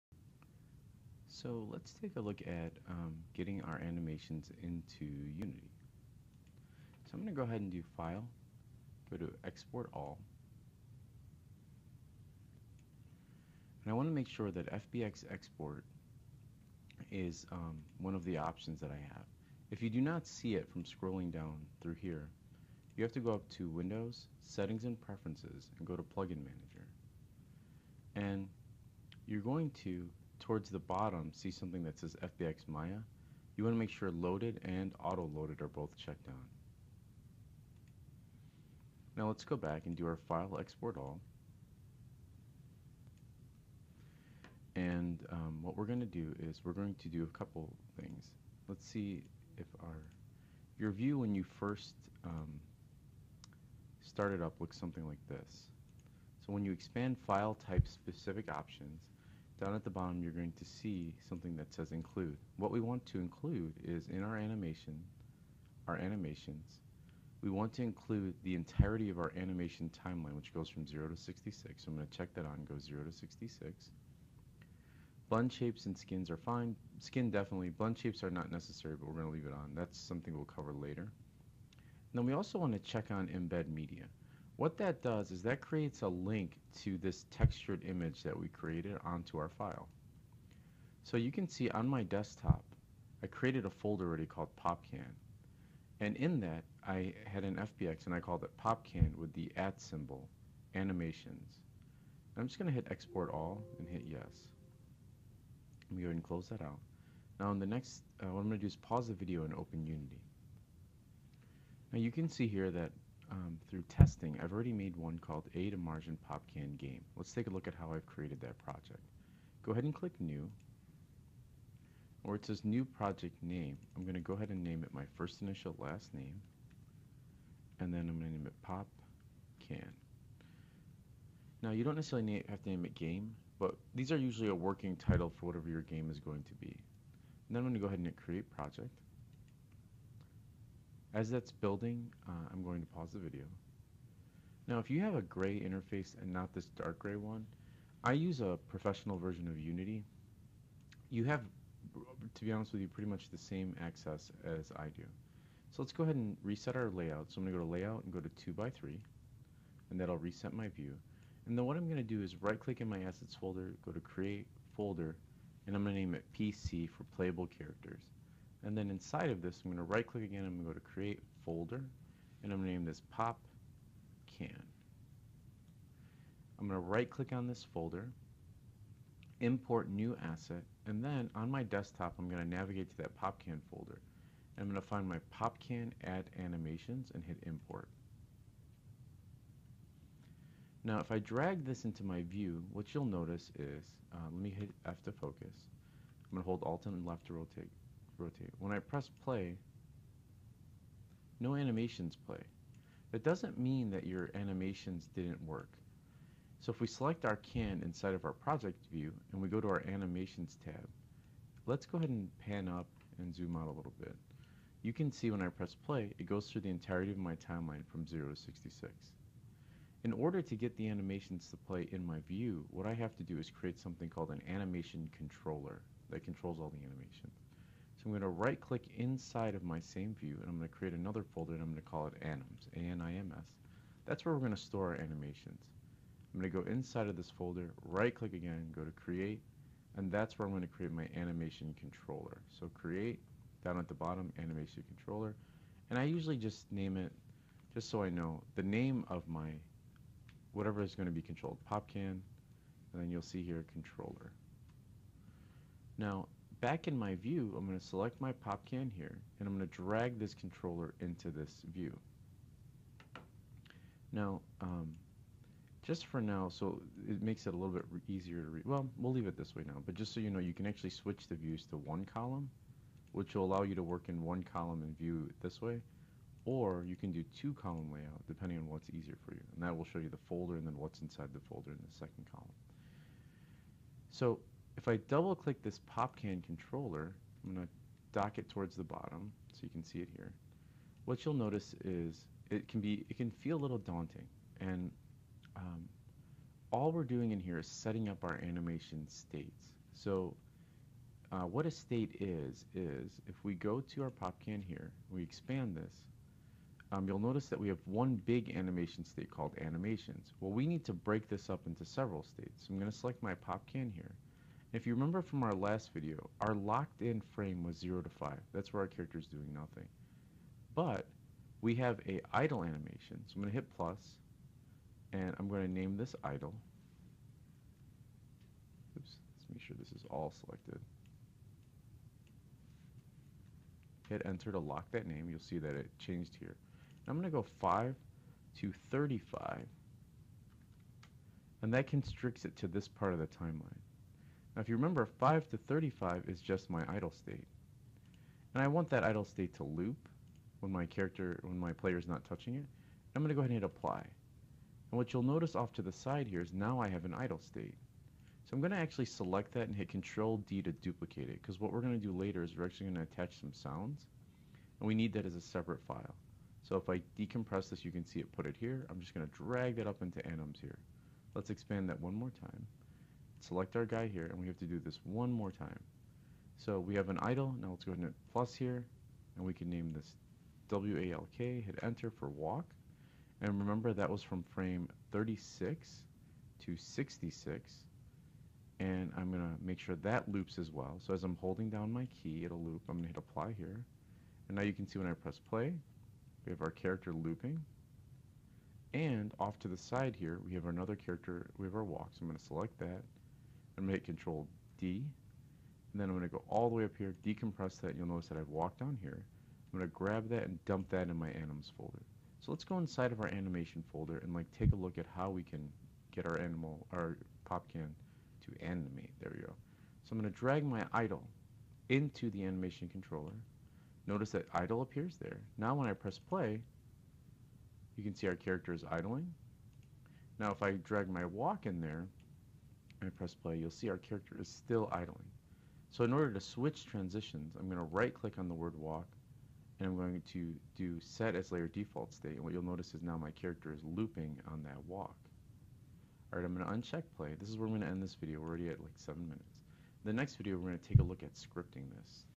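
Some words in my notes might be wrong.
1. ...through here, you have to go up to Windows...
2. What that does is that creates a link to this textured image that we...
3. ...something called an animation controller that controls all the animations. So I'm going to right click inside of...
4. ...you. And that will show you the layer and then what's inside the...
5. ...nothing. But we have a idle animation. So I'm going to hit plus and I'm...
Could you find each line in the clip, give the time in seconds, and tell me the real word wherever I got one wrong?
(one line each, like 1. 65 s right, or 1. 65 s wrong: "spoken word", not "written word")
1. 21 s right
2. 84 s right
3. 223 s right
4. 279 s wrong: "folder", not "layer"
5. 319 s right.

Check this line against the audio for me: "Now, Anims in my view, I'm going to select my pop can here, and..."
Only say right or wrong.
wrong.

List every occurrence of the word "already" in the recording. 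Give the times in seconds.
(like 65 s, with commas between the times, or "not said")
94 s, 114 s, 448 s.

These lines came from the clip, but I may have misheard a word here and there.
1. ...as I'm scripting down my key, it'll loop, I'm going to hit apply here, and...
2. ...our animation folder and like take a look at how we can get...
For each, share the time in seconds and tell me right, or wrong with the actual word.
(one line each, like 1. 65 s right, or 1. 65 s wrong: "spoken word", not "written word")
1. 391 s wrong: "holding", not "scripting"
2. 413 s right.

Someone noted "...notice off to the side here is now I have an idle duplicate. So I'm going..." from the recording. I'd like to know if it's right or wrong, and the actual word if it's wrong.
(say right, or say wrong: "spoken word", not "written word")
wrong: "state", not "duplicate".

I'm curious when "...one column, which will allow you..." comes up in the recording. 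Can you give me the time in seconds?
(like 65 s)
271 s.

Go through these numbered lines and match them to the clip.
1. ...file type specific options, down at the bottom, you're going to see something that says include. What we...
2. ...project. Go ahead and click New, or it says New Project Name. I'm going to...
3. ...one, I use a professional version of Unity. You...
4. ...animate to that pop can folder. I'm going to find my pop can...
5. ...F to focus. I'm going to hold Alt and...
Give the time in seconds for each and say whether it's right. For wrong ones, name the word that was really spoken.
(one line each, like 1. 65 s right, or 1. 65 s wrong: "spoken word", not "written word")
1. 57 s right
2. 118 s right
3. 147 s right
4. 182 s wrong: "navigate", not "animate"
5. 194 s right.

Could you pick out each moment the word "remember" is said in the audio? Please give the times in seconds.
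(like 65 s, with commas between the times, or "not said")
314 s, 344 s, 383 s.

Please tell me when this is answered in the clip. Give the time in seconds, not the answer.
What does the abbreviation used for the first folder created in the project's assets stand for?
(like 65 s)
167 s.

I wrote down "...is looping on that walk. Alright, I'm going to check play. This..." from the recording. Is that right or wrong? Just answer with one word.
wrong.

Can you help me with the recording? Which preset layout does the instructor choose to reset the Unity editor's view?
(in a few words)
2x3.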